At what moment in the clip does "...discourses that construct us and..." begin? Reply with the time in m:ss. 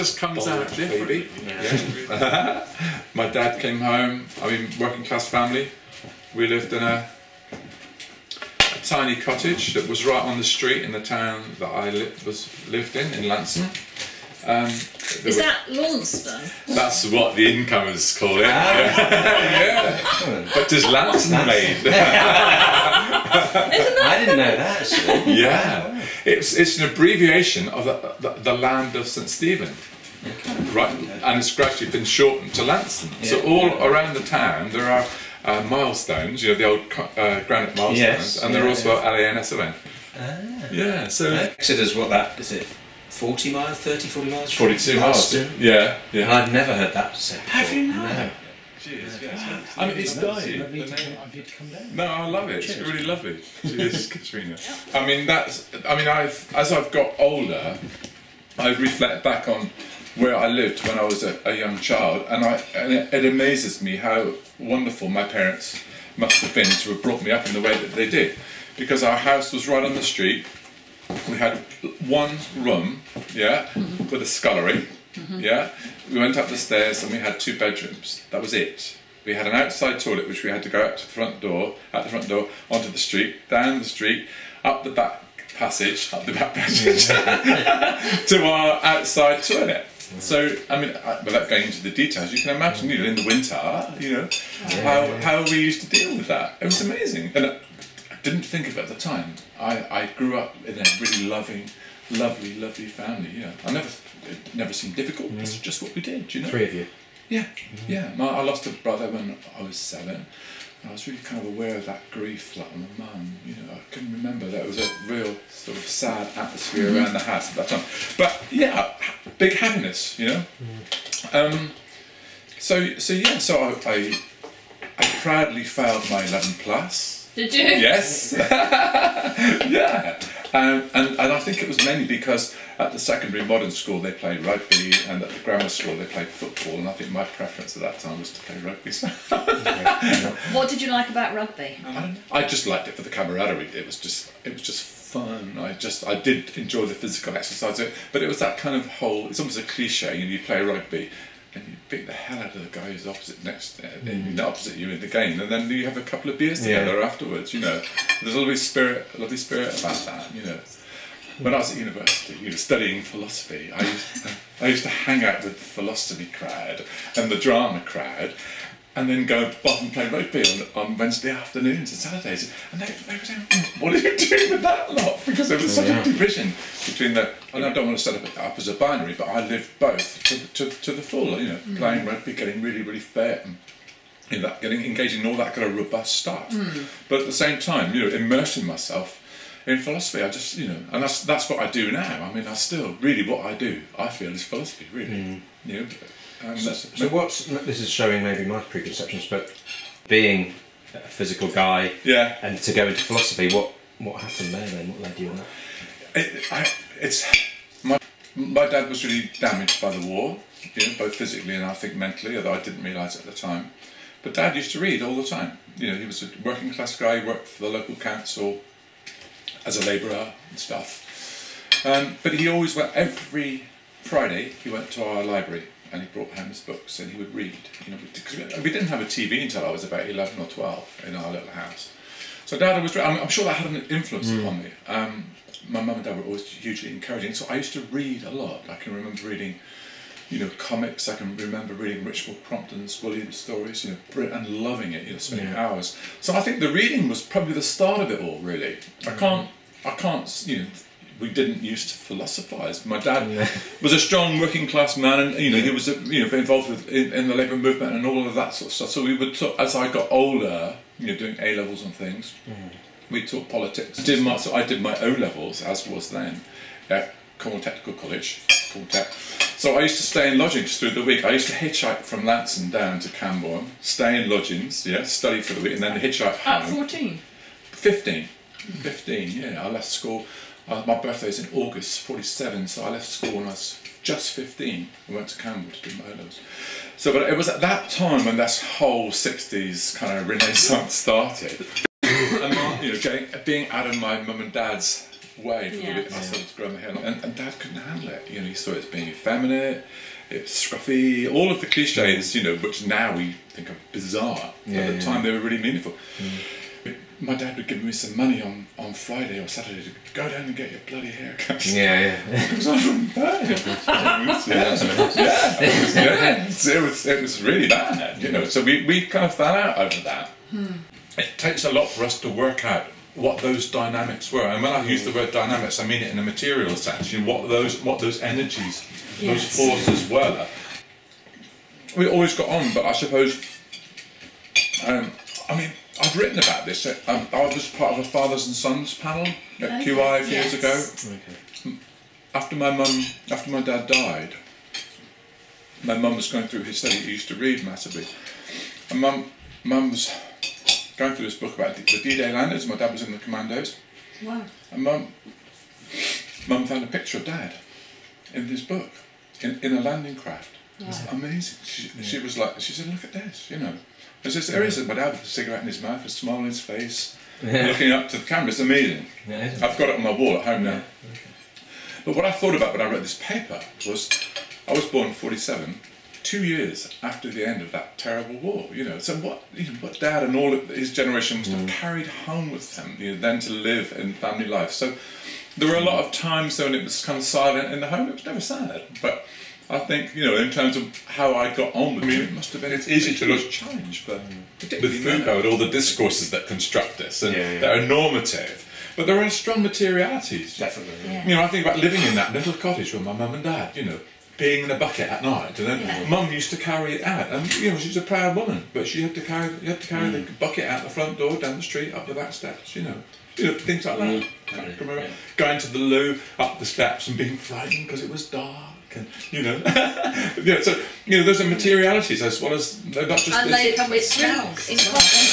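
6:35.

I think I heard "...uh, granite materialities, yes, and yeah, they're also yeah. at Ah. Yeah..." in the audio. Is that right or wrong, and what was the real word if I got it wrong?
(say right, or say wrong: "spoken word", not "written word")
wrong: "milestones", not "materialities".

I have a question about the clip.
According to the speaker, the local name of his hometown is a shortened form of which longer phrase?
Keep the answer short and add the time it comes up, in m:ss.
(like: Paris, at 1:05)
the land of St. Stephen, at 0:28.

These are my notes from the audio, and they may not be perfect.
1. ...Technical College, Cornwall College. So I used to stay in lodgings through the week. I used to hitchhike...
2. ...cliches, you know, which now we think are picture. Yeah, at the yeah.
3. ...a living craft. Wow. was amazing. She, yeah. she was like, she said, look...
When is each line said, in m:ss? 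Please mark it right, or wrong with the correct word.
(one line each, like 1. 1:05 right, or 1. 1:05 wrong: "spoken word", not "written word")
1. 4:27 wrong: "Tech", not "College"
2. 5:01 wrong: "bizarre", not "picture"
3. 5:59 wrong: "landing", not "living".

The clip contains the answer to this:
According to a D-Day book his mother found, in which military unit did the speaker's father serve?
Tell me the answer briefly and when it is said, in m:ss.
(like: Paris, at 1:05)
the commandos, at 5:53.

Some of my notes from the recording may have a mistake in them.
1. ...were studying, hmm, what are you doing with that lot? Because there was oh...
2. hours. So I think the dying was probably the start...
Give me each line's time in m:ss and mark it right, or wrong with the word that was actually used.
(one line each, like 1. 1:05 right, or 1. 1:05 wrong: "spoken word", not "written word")
1. 2:53 wrong: "saying", not "studying"
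2. 4:05 wrong: "reading", not "dying".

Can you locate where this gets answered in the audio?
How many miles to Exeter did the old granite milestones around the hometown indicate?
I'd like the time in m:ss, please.
0:44.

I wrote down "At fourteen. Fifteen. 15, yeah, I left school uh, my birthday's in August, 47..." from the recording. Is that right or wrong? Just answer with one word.
right.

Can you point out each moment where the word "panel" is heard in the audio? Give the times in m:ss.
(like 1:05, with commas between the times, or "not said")
5:38.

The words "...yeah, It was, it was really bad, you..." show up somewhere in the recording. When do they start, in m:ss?
5:14.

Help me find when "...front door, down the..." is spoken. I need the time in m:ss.
6:50.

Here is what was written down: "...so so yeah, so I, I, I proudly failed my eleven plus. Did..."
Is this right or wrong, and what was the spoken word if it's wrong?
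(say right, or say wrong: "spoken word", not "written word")
right.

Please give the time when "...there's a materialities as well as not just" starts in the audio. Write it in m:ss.
7:01.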